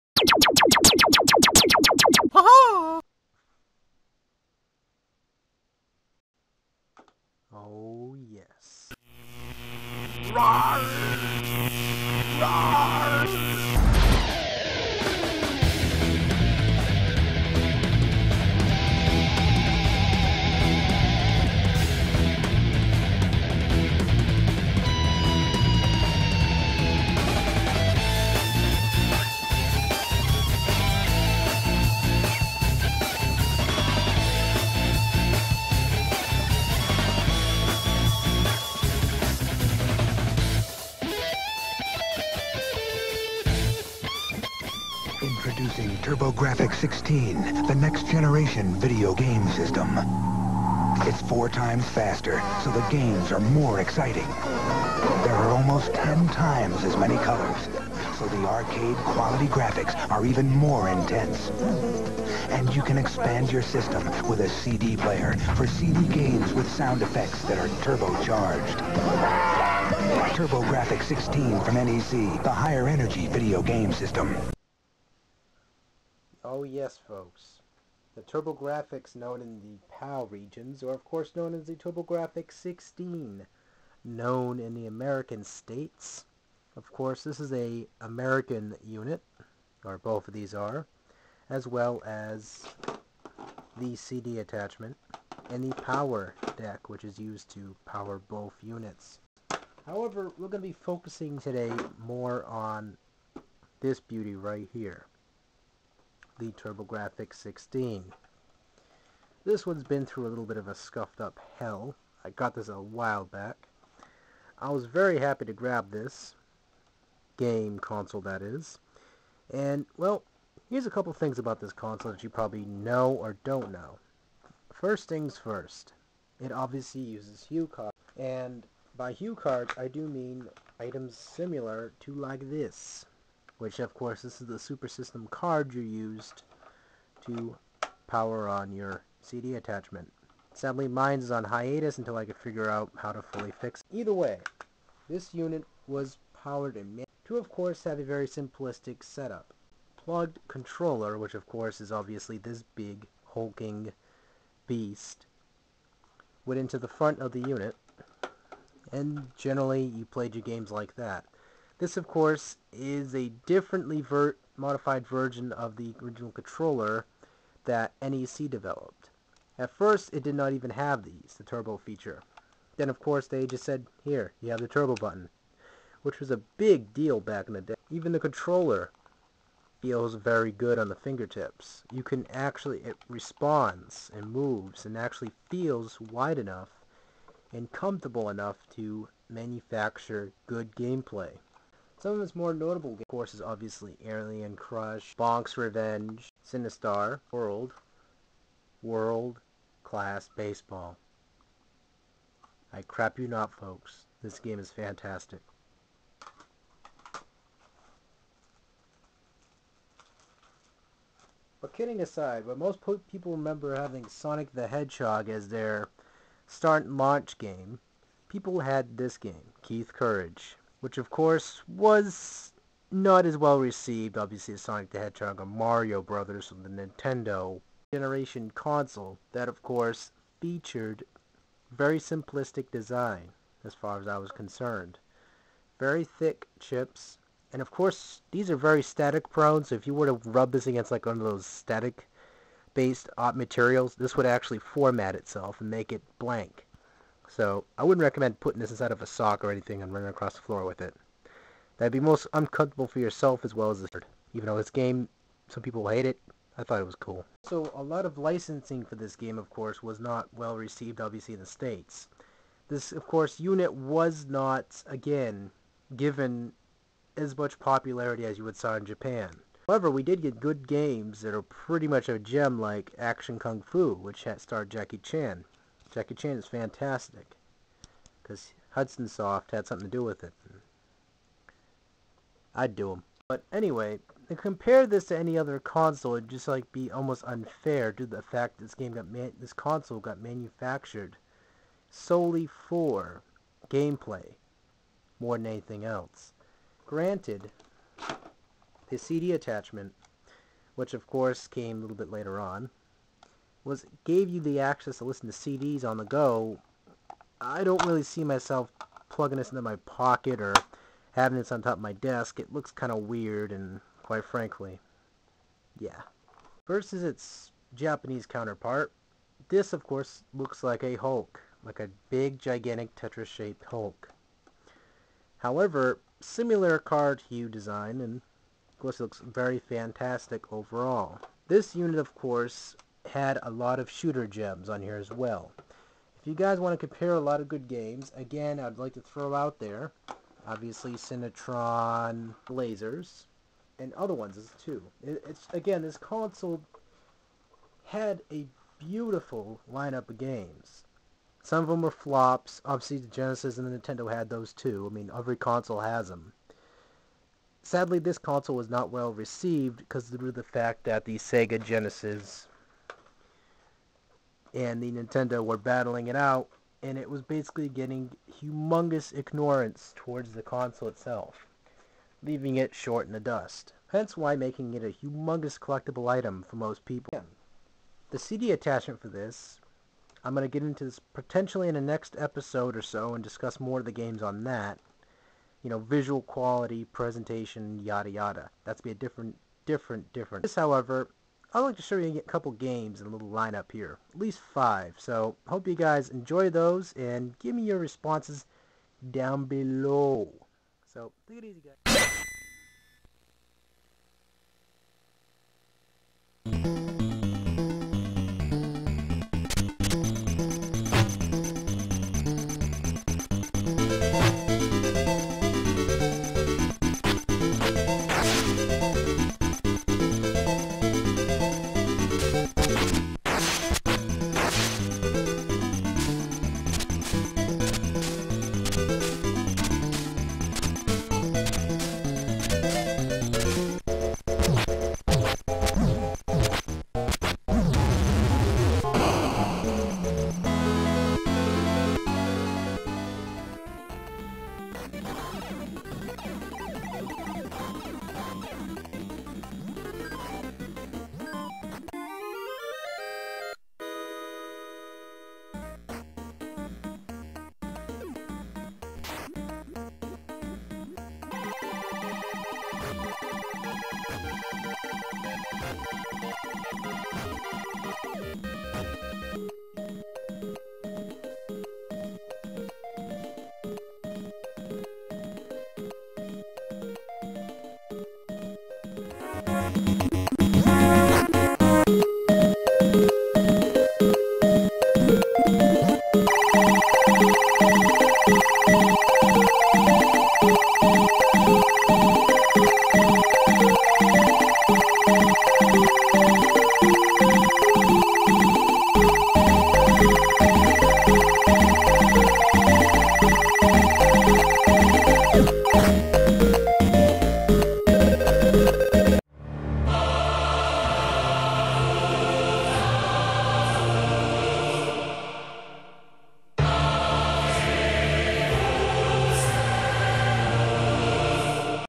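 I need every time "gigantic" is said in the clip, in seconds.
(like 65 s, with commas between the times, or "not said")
322 s.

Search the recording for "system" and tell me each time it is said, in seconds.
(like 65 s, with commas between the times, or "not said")
49 s, 63 s, 73 s, 134 s.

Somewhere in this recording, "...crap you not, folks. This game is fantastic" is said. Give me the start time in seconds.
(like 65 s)
202 s.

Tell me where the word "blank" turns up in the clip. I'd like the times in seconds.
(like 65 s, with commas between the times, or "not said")
246 s.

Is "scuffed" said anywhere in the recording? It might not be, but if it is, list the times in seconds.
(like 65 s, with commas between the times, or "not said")
110 s.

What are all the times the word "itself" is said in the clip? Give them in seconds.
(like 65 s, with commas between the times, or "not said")
245 s, 370 s.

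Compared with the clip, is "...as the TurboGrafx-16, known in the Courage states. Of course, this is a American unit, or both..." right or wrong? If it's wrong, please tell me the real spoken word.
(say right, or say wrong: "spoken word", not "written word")
wrong: "American", not "Courage".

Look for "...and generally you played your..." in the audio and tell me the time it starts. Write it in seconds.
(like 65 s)
158 s.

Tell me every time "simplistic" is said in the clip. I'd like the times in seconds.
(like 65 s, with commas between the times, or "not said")
148 s, 231 s.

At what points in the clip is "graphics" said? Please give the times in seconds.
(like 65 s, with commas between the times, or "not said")
59 s.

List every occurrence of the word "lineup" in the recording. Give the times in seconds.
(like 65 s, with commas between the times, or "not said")
349 s, 393 s.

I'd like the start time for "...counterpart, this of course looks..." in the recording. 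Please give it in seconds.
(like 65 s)
318 s.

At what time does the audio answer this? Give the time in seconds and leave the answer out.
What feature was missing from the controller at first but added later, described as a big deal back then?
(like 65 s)
174 s.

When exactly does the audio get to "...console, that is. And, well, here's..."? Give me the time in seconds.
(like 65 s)
117 s.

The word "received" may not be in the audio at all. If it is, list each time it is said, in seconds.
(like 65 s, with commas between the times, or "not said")
223 s, 260 s, 359 s.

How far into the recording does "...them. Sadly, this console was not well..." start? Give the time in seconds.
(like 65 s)
356 s.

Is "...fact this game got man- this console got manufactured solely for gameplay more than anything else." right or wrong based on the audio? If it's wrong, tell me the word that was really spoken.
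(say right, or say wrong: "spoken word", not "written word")
right.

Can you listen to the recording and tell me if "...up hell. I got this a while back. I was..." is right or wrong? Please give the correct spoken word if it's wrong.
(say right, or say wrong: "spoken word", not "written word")
right.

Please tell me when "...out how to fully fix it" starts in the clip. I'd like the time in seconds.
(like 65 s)
142 s.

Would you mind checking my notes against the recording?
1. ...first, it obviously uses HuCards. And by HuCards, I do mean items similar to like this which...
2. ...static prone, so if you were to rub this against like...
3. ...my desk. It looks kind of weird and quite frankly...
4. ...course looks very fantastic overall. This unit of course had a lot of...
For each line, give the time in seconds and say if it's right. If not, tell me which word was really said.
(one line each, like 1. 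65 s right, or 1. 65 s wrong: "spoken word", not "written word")
1. 125 s right
2. 238 s right
3. 311 s right
4. 328 s right.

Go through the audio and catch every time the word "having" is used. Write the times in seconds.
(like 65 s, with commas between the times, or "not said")
213 s, 311 s.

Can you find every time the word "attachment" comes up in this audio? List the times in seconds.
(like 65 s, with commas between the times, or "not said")
94 s, 139 s, 299 s, 378 s.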